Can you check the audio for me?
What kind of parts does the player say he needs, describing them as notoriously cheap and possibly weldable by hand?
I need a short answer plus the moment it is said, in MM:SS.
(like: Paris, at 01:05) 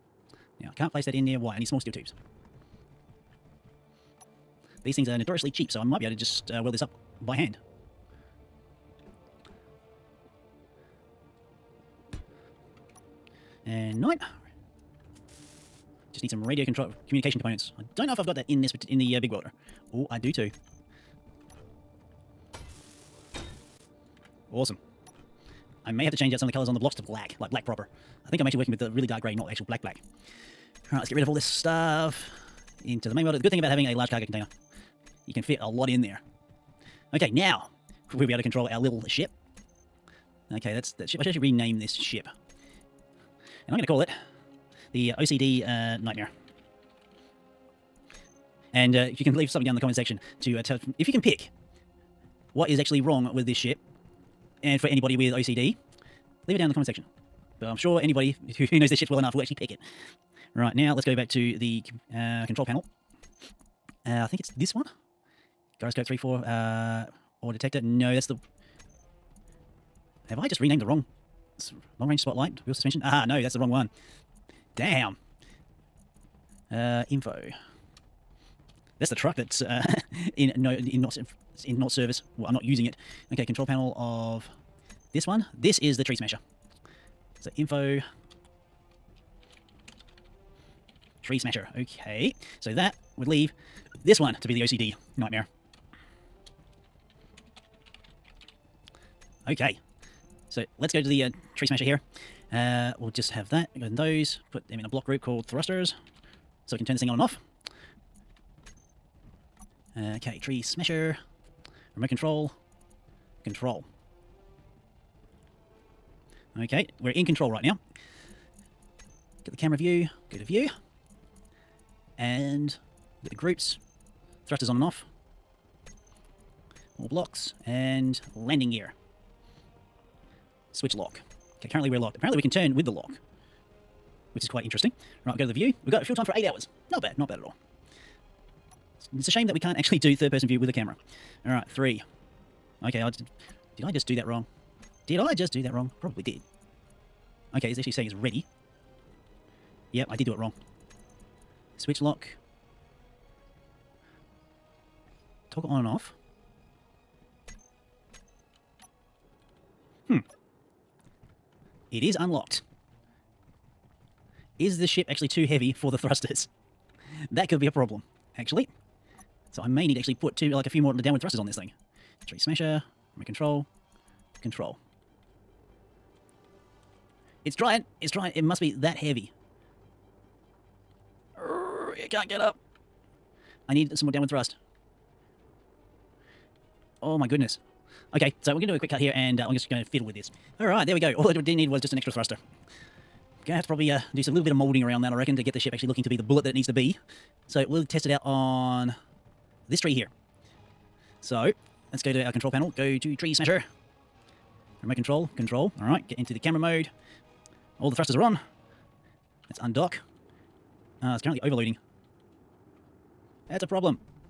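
small steel tubes, at 00:01.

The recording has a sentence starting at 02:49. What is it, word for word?
So I may need to actually put two, like a few more downward thrusters on this thing.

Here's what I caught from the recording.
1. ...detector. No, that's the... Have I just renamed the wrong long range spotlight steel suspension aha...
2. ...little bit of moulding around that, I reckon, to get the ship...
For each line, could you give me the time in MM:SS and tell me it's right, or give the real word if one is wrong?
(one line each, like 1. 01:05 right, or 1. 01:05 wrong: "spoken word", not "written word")
1. 01:07 wrong: "wheel", not "steel"
2. 03:14 right.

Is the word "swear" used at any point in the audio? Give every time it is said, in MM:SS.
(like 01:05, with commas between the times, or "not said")
not said.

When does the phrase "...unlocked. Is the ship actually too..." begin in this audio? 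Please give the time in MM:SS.
02:42.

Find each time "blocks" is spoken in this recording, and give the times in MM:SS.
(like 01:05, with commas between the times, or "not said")
00:26, 01:44, 02:07.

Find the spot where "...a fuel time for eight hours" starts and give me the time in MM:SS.
02:16.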